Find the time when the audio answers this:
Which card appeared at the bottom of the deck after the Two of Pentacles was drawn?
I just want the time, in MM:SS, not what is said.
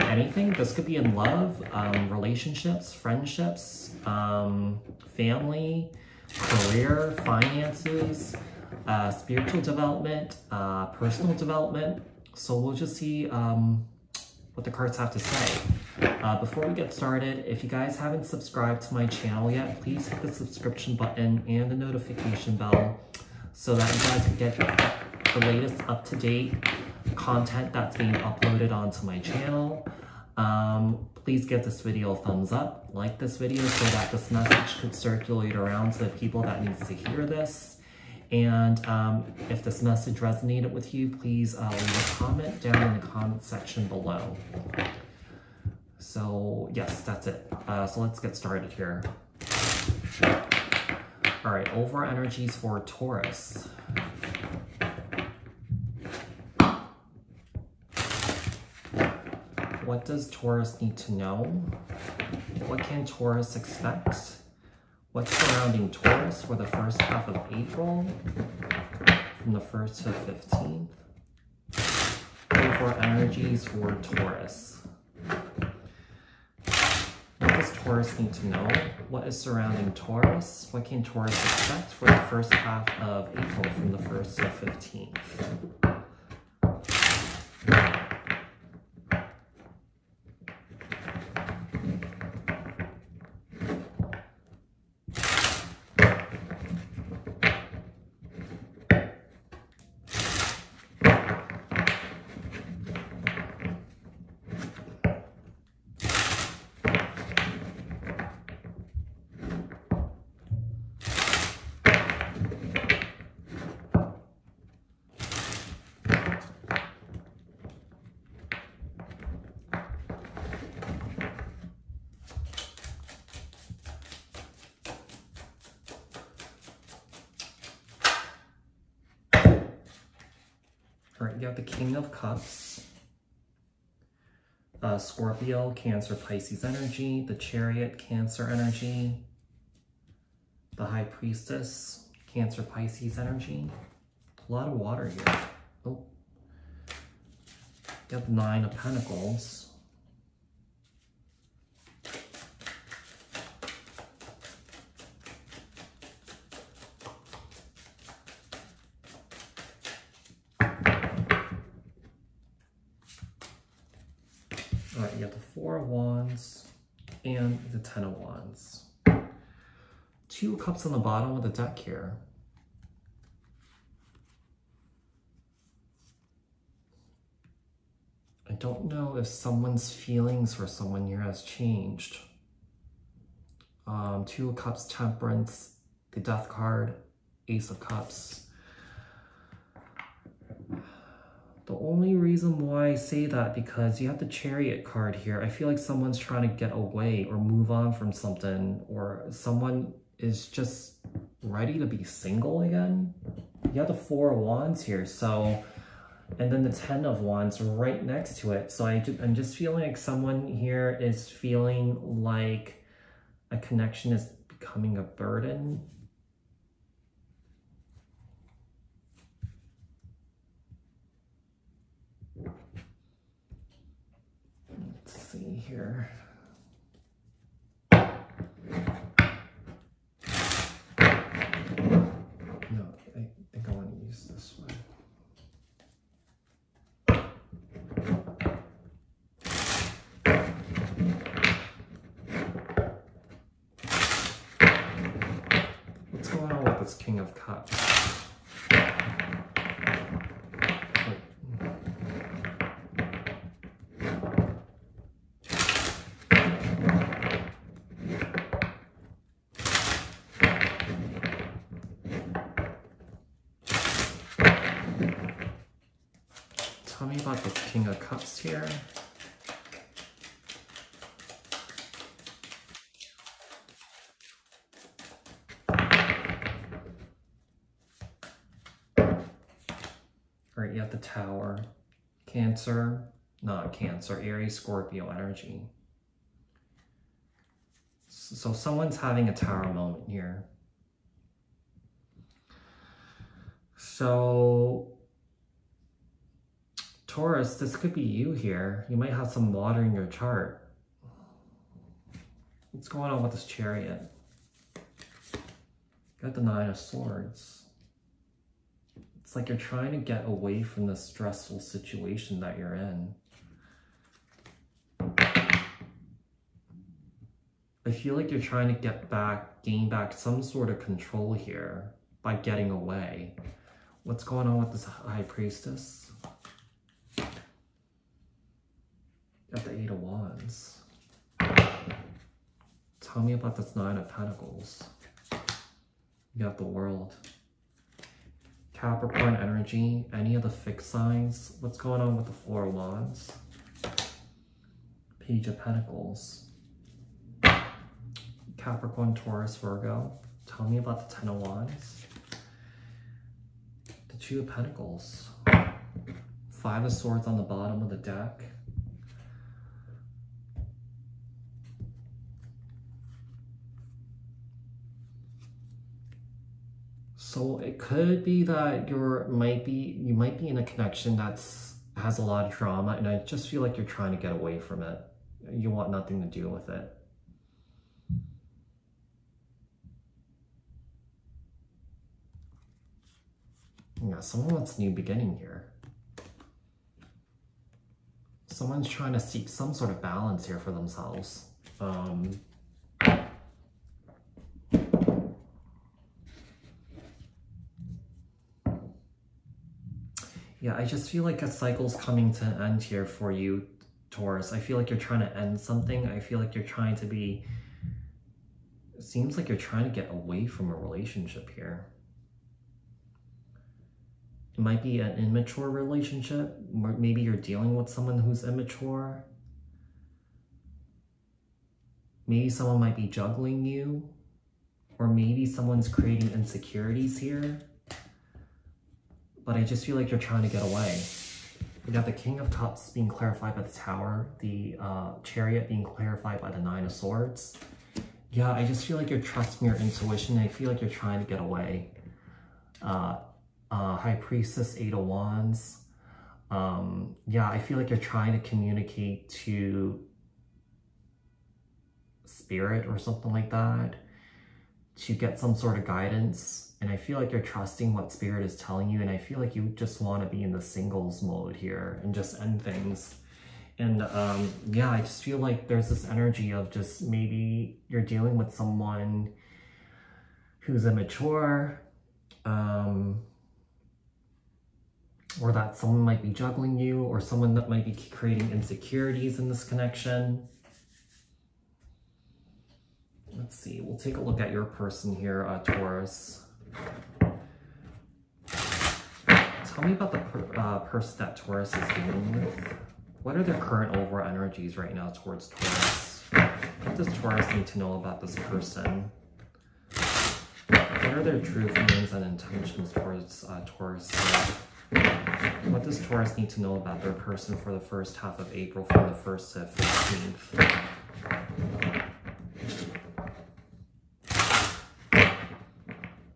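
05:56.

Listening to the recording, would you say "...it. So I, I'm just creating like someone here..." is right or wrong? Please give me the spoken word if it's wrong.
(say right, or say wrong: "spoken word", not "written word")
wrong: "feeling", not "creating".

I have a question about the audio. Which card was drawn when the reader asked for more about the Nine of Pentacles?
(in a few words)
The World.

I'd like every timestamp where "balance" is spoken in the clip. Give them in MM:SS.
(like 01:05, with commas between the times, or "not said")
06:30.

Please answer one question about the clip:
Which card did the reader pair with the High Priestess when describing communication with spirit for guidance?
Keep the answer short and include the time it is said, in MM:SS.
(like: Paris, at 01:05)
Eight of Wands, at 07:24.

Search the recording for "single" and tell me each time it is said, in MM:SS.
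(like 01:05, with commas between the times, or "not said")
03:22, 07:40.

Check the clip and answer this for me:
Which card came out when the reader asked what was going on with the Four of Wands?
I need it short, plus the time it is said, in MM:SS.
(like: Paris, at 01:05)
Page of Pentacles, at 05:45.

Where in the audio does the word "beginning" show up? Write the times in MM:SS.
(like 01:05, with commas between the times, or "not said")
06:24.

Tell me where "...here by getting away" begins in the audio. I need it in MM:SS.
05:21.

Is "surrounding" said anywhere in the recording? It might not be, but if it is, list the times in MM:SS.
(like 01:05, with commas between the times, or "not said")
01:05, 01:19.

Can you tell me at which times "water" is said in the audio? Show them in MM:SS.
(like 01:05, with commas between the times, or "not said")
02:24, 04:59.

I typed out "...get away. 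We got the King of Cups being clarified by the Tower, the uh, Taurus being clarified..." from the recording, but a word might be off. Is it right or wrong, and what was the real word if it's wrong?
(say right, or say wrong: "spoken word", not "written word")
wrong: "Chariot", not "Taurus".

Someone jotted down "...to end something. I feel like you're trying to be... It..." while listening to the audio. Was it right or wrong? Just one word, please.
right.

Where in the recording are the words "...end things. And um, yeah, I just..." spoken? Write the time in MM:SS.
07:42.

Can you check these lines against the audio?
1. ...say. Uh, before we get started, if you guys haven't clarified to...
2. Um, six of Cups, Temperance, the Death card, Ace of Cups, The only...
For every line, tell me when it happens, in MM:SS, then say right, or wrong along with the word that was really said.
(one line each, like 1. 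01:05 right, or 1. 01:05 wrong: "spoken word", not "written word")
1. 00:15 wrong: "subscribed", not "clarified"
2. 03:03 wrong: "two", not "six".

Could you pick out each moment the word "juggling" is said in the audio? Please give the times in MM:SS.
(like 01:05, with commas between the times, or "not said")
07:03, 07:56.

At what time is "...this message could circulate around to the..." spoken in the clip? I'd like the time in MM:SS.
00:34.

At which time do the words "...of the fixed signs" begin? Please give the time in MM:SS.
05:40.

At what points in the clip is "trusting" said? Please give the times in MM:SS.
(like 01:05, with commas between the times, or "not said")
07:19, 07:37.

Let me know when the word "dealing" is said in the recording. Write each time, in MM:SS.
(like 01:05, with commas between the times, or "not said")
06:57, 07:48, 08:11.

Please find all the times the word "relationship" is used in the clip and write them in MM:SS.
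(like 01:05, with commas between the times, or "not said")
00:02, 06:50, 06:55.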